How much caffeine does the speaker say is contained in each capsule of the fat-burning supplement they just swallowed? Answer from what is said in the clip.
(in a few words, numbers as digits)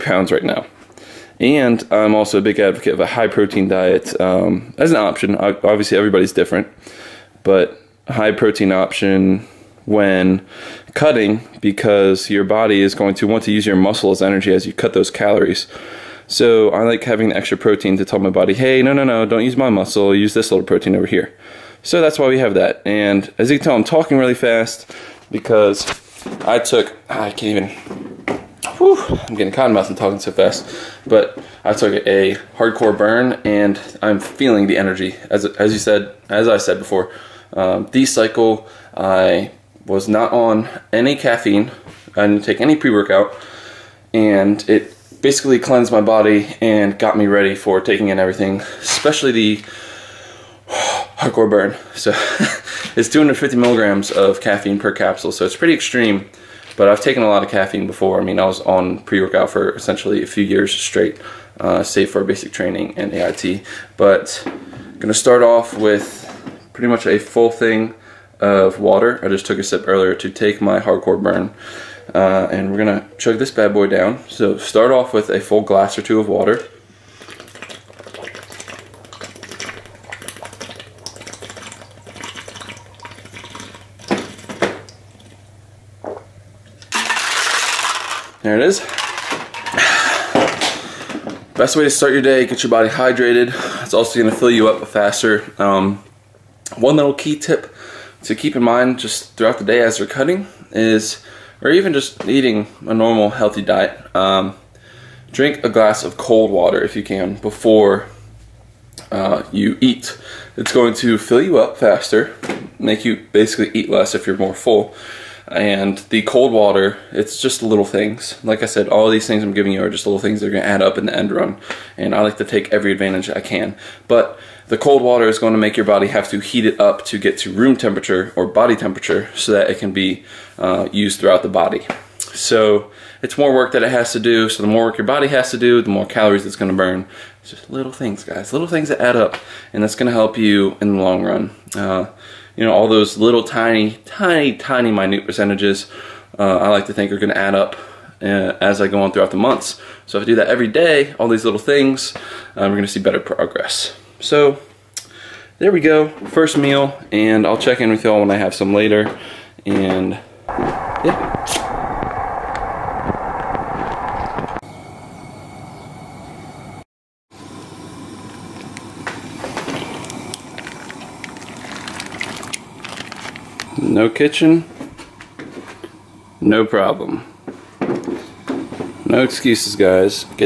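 250 milligrams.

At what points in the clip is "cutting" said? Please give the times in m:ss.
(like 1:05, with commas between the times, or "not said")
0:10, 1:40.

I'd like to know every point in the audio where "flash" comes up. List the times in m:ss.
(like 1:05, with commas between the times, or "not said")
not said.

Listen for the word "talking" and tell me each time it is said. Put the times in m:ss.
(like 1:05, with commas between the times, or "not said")
0:23, 0:29.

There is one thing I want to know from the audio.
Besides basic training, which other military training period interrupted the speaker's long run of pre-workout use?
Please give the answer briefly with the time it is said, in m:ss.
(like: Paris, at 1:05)
AIT, at 1:03.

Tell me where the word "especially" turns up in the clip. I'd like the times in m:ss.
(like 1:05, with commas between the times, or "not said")
0:48.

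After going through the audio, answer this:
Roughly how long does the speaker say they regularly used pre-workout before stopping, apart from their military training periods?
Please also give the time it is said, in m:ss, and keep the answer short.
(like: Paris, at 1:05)
a few years, at 1:00.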